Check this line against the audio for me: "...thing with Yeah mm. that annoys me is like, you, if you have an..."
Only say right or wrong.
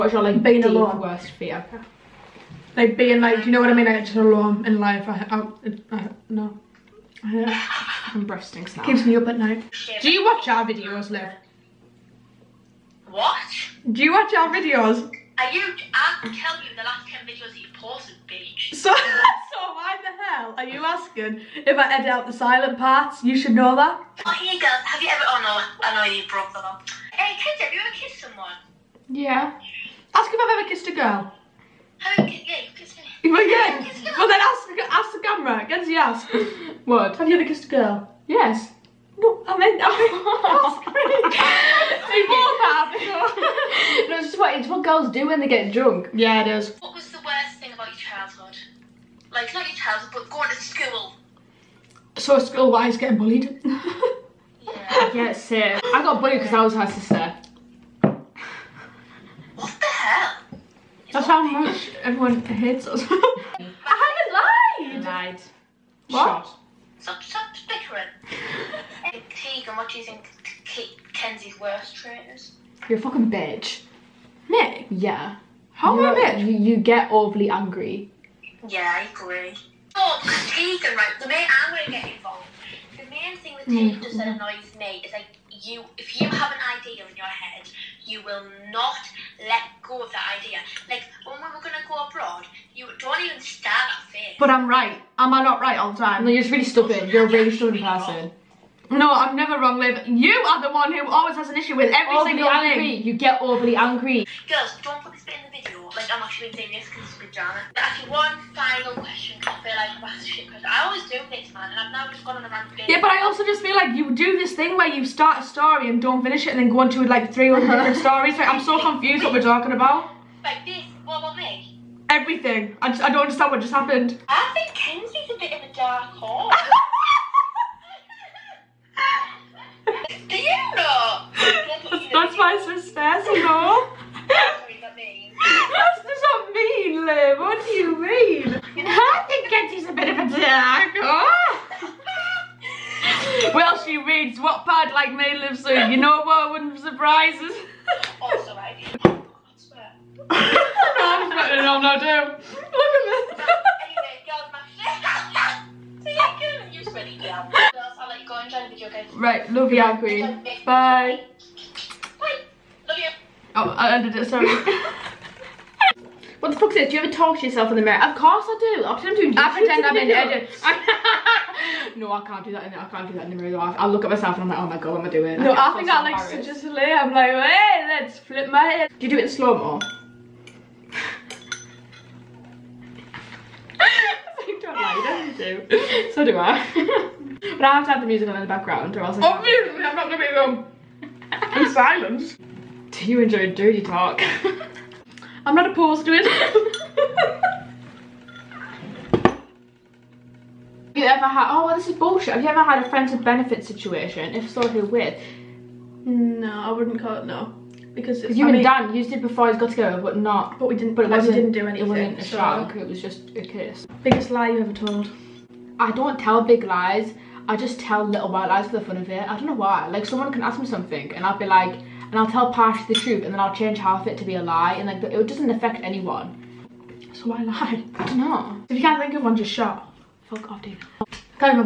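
wrong.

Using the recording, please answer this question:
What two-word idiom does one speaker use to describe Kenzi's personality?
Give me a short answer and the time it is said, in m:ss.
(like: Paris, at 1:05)
dark horse, at 2:05.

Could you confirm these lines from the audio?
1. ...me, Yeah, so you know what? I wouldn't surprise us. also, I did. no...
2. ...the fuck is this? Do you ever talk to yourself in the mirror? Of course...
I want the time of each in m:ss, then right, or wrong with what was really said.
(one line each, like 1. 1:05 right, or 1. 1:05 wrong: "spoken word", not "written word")
1. 2:25 wrong: "Liv", not "Yeah"
2. 2:46 right.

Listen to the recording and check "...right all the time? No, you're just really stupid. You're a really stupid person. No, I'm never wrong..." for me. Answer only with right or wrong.
right.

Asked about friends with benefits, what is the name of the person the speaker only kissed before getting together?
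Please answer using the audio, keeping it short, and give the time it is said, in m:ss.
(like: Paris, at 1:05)
Dan, at 3:28.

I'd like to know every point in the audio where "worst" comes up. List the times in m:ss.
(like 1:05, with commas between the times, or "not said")
0:01, 0:47, 1:11.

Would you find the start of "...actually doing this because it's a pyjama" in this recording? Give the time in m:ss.
1:46.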